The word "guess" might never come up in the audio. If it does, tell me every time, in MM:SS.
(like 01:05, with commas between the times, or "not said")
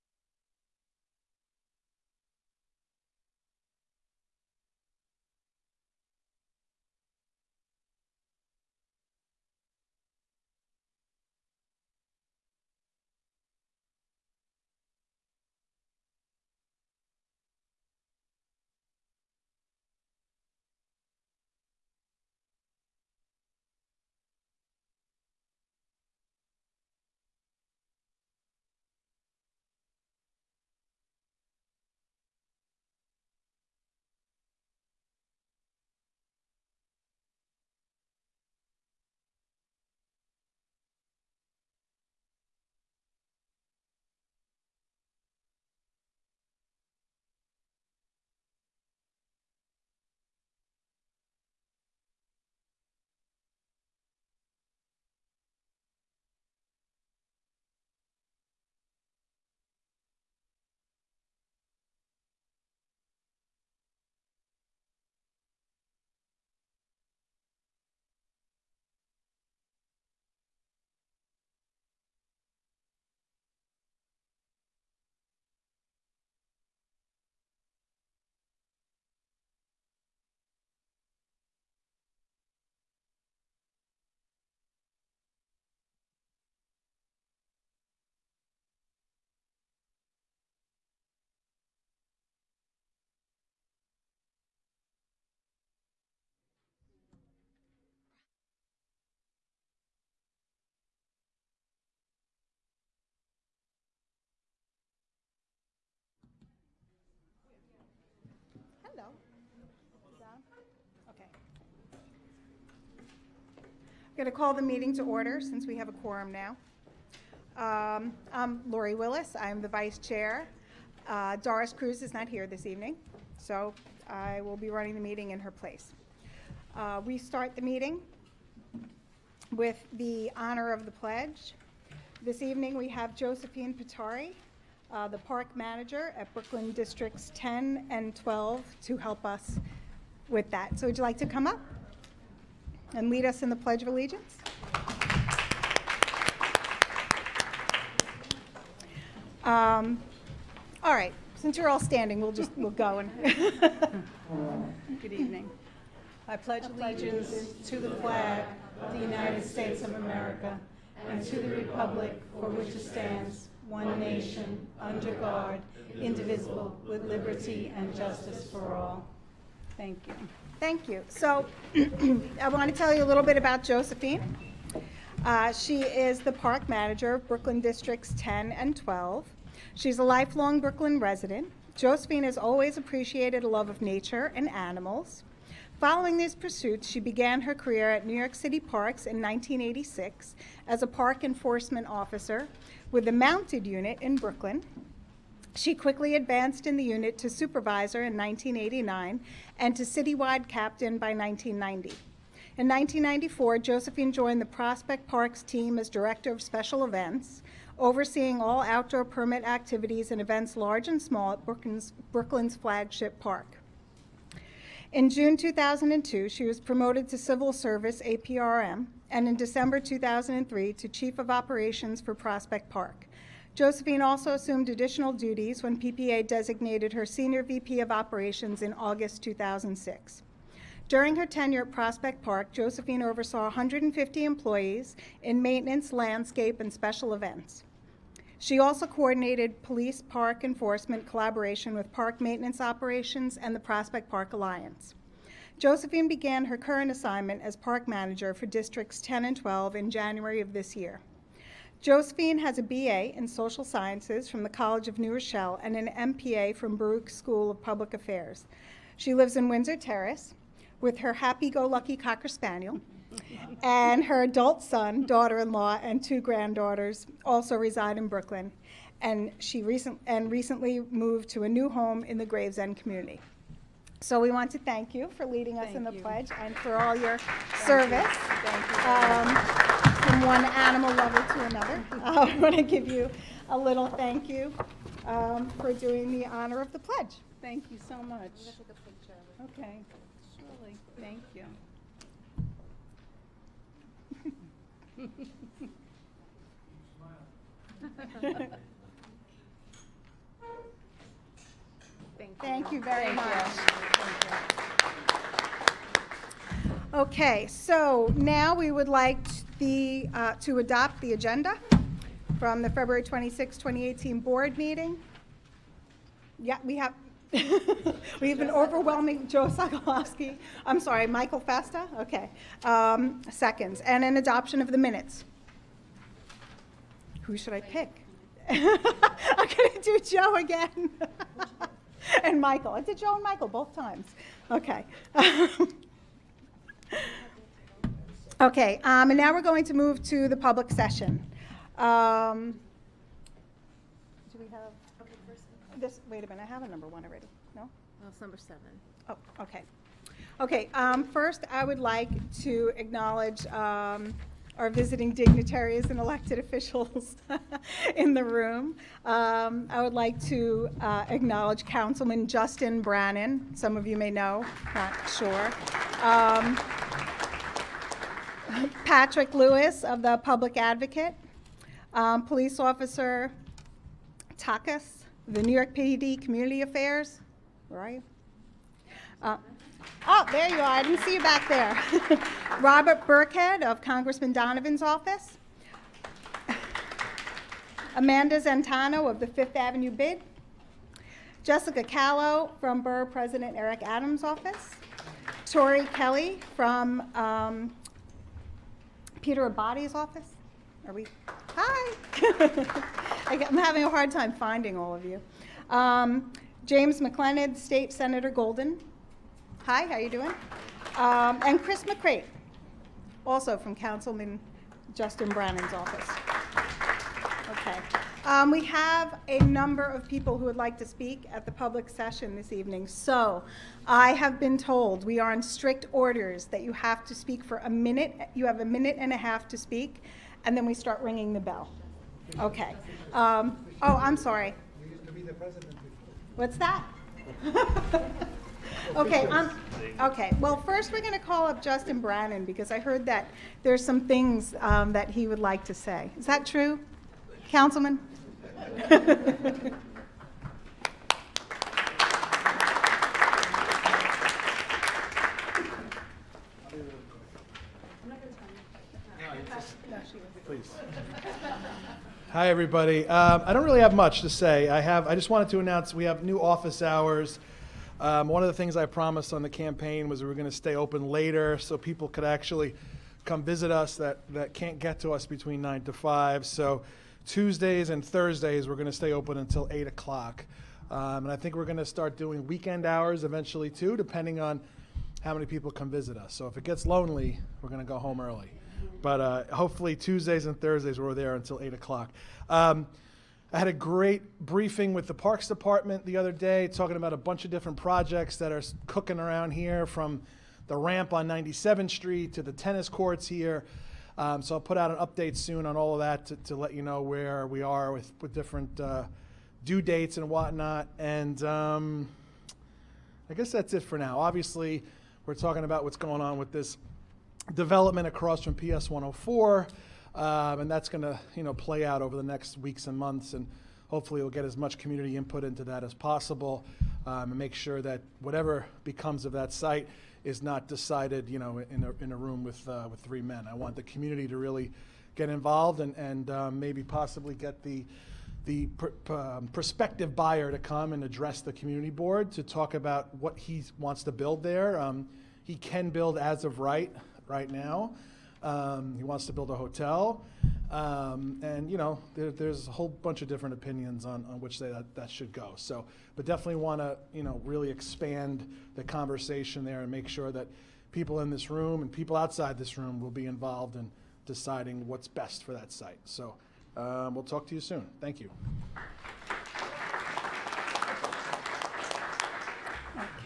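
08:33.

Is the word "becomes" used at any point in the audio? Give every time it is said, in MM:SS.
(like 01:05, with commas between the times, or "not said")
08:48.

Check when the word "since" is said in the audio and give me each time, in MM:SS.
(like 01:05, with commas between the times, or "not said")
01:55, 02:31.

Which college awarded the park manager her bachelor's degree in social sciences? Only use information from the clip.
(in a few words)
College of New Rochelle.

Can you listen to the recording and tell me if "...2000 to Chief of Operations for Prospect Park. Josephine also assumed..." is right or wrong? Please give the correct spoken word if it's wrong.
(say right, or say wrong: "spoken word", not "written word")
wrong: "2003", not "2000".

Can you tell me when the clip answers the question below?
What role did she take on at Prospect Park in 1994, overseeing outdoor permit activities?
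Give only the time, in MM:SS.
03:25.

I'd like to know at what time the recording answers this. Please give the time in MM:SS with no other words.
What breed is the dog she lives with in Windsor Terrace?
04:21.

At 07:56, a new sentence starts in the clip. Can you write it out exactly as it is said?
So Tuesdays and Thursdays, we're going to stay open until 8 o'clock.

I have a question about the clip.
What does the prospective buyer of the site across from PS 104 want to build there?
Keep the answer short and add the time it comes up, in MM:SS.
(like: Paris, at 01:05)
a hotel, at 09:09.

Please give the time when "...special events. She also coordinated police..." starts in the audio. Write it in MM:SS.
03:56.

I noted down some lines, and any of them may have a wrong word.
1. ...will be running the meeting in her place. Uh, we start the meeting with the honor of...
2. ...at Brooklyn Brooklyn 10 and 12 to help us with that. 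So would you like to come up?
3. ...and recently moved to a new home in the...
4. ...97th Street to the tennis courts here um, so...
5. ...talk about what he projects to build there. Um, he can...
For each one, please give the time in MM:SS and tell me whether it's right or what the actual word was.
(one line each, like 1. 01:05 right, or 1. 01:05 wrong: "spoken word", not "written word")
1. 02:04 right
2. 02:16 wrong: "Districts", not "Brooklyn"
3. 04:30 right
4. 08:21 right
5. 09:02 wrong: "wants", not "projects".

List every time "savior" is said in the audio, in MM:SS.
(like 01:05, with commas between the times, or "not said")
not said.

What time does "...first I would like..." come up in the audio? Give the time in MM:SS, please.
05:51.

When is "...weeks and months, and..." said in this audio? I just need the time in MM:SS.
08:42.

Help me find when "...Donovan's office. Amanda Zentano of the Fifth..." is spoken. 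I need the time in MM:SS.
06:24.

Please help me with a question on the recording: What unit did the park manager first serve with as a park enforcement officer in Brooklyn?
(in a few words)
Mounted Unit.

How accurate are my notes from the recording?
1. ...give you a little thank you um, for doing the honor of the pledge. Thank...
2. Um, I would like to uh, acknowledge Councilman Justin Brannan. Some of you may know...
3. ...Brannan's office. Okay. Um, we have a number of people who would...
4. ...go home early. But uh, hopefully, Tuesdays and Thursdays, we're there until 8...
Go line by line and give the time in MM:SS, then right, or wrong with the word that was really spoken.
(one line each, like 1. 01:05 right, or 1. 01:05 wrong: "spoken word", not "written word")
1. 04:42 right
2. 05:59 right
3. 06:55 right
4. 08:07 right.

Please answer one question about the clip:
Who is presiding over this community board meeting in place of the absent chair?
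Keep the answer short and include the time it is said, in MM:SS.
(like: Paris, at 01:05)
Lori Willis, at 01:58.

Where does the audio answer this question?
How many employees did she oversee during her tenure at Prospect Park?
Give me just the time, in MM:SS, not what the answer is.
03:53.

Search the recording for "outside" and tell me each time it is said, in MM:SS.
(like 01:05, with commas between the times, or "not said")
09:22.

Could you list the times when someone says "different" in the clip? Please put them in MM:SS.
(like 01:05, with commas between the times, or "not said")
08:17, 08:28, 09:13.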